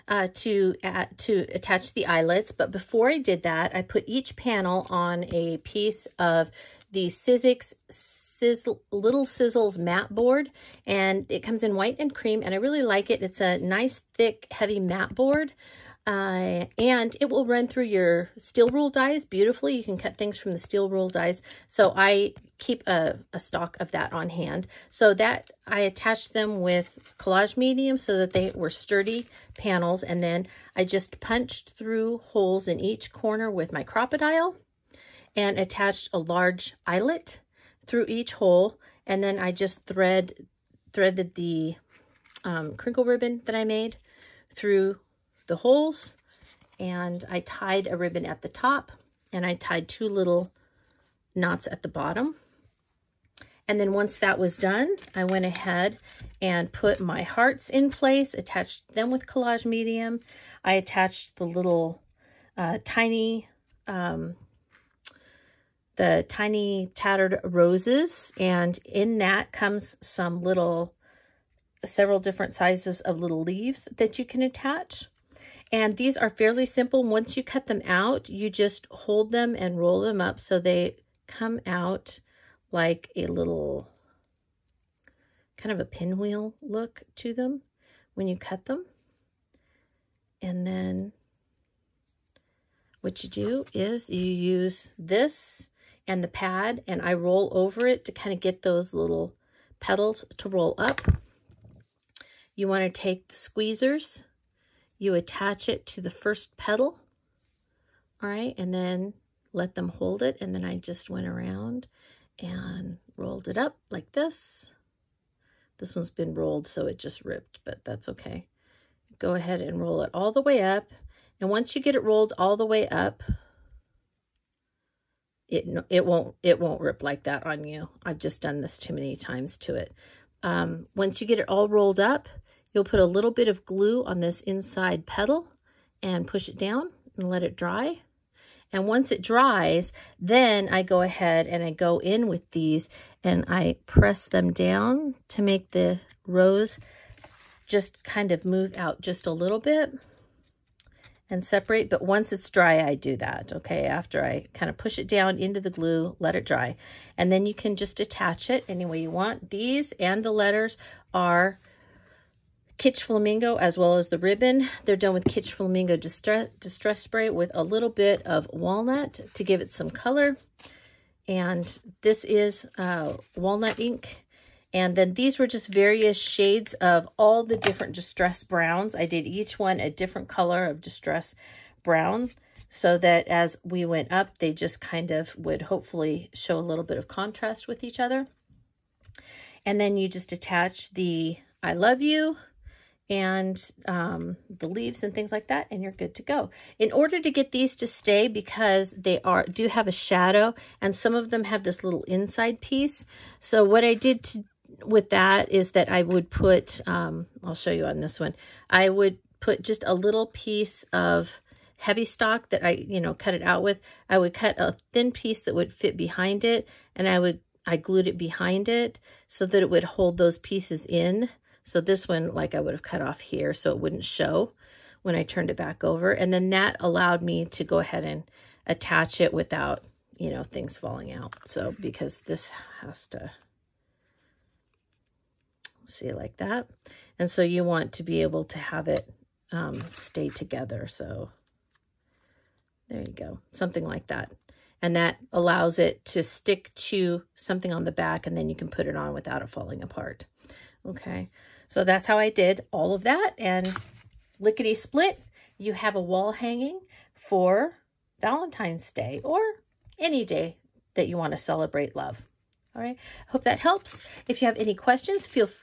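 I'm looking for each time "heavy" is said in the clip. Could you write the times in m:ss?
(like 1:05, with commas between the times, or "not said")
0:14, 3:31.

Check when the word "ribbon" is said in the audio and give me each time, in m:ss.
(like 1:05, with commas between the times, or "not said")
0:43, 0:47, 2:44.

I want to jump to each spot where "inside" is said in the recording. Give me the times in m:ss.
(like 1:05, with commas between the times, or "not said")
2:14, 3:22.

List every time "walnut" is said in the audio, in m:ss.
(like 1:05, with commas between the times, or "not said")
2:48, 2:53.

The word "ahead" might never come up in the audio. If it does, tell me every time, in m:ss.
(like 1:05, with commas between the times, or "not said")
0:55, 1:59, 2:21, 3:47.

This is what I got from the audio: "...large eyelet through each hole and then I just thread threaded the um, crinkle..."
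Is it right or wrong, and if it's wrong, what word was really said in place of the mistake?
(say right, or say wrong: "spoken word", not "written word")
right.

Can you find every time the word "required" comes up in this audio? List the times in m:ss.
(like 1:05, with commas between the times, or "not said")
not said.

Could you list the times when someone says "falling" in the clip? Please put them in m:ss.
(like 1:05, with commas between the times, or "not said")
3:50, 4:09.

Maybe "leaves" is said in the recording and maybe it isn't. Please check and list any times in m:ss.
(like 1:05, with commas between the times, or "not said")
1:13, 3:14.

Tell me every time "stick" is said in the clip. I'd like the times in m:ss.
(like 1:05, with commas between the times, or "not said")
4:06.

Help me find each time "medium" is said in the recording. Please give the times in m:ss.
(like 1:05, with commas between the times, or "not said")
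0:27, 0:59.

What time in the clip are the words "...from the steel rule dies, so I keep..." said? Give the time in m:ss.
0:20.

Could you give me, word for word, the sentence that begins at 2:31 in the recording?
But once it's dry, I do that, okay?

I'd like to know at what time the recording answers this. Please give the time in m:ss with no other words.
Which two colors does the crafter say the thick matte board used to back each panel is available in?
0:11.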